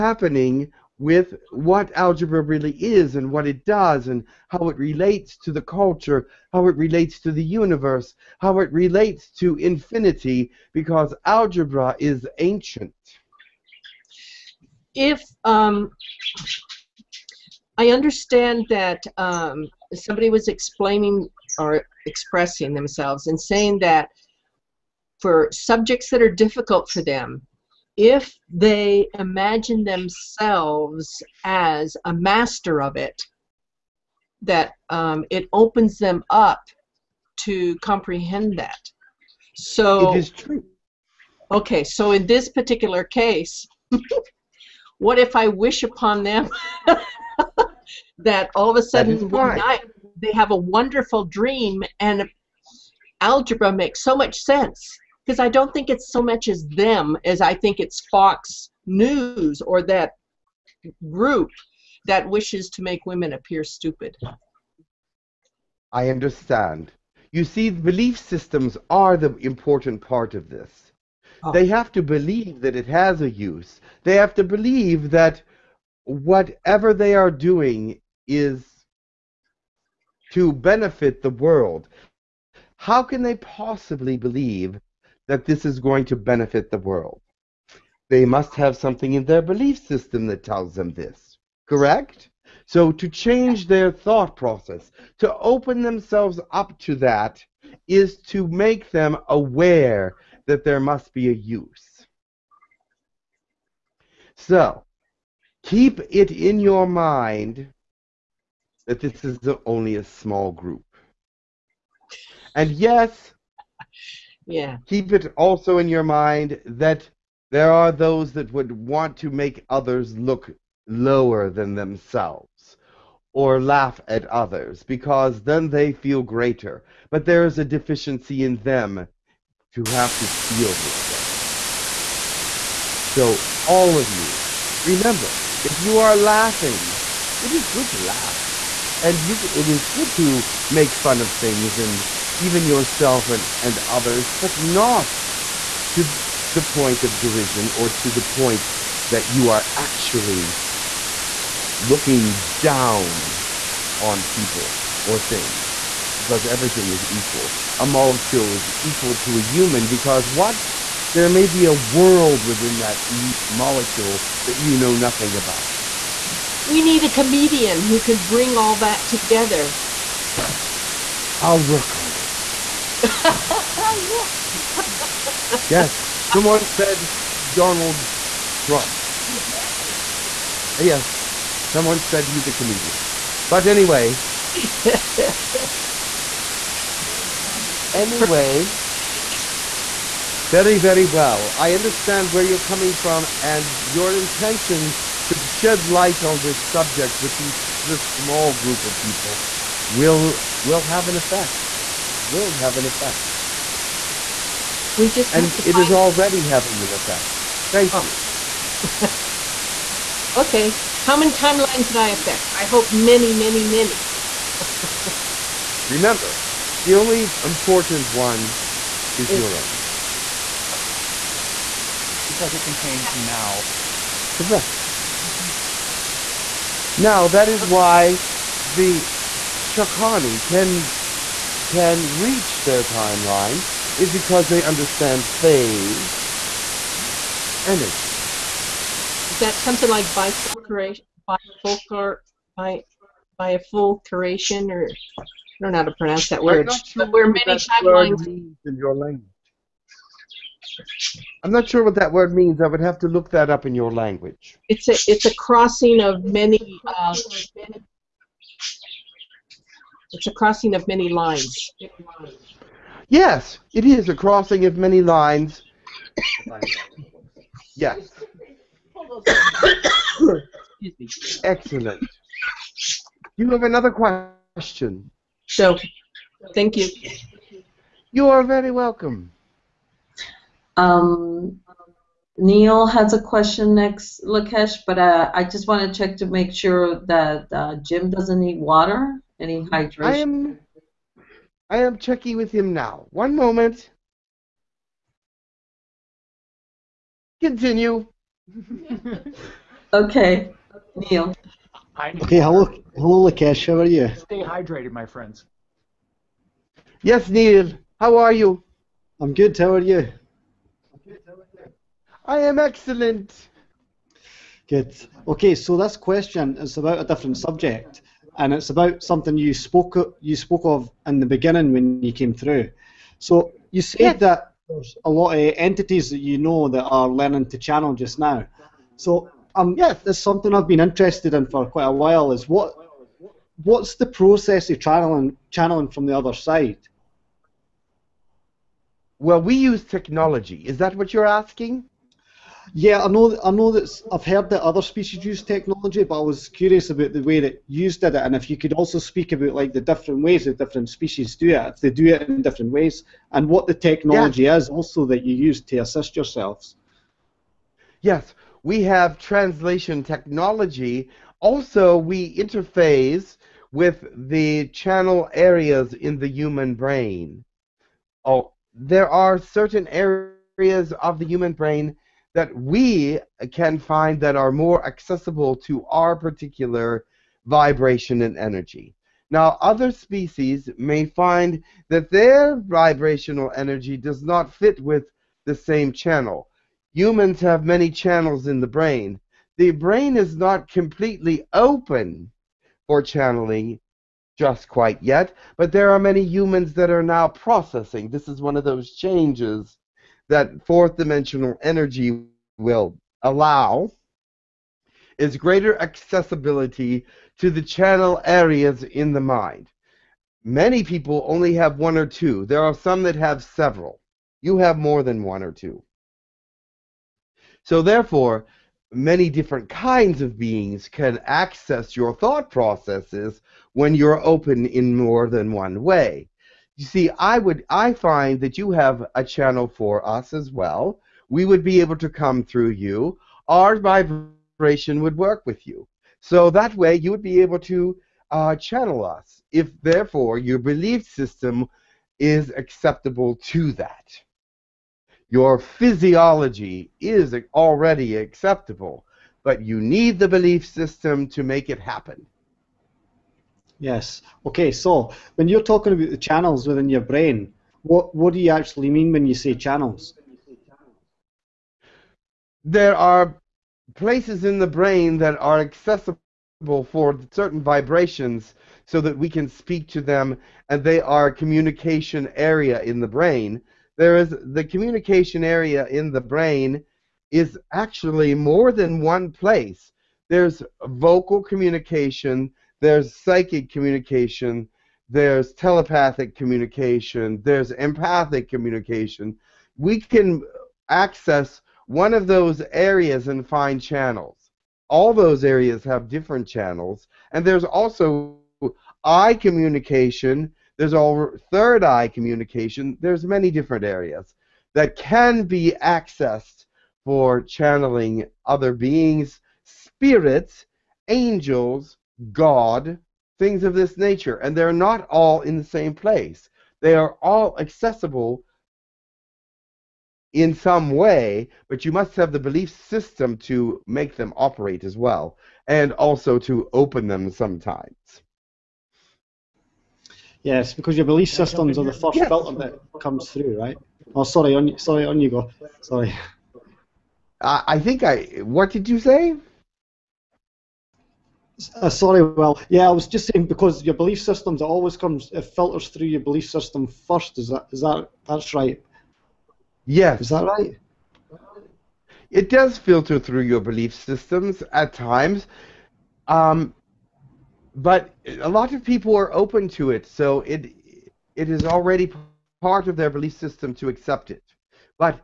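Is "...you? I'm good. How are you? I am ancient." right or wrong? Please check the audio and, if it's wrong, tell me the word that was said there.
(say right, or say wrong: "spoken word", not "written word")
wrong: "excellent", not "ancient".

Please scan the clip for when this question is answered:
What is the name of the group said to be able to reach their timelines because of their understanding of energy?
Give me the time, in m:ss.
3:49.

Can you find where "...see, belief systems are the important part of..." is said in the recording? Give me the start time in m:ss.
1:07.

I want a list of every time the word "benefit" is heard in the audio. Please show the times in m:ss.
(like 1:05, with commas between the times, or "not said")
1:20, 1:26.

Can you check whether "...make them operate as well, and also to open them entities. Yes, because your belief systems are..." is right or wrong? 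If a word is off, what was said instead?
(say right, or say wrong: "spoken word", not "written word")
wrong: "sometimes", not "entities".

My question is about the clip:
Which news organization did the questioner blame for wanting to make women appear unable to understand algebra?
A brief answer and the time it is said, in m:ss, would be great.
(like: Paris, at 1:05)
Fox News, at 0:58.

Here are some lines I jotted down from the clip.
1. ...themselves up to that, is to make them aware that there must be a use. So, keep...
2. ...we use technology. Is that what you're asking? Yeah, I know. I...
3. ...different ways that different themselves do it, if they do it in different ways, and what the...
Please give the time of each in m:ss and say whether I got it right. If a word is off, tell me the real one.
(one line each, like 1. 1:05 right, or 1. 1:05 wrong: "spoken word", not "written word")
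1. 1:35 right
2. 5:39 right
3. 5:49 wrong: "species", not "themselves".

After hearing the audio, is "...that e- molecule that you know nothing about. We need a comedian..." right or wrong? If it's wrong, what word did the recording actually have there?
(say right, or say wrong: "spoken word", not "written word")
right.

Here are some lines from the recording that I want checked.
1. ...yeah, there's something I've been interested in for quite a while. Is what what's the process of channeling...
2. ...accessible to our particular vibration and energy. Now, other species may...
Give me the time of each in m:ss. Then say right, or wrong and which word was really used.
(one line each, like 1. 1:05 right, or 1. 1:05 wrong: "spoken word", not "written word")
1. 5:29 right
2. 6:14 right.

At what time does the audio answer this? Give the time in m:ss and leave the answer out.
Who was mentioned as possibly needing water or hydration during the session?
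4:47.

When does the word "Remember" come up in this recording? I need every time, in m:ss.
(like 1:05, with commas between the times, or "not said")
2:14, 3:35.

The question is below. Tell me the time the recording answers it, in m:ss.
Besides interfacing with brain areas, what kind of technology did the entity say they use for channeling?
5:59.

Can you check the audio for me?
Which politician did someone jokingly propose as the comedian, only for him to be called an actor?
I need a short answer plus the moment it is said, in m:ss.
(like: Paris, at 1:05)
Donald Trump, at 2:57.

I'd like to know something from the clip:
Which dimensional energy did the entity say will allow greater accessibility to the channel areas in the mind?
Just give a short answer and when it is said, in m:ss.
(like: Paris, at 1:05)
fourth dimensional, at 6:40.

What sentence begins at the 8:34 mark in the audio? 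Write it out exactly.
And they're not all in the same place.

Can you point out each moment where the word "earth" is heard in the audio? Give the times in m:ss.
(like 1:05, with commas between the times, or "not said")
not said.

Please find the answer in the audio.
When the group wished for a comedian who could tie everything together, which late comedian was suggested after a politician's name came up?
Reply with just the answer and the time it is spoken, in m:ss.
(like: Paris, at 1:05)
George Carlin, at 3:04.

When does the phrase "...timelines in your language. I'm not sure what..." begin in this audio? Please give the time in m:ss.
4:07.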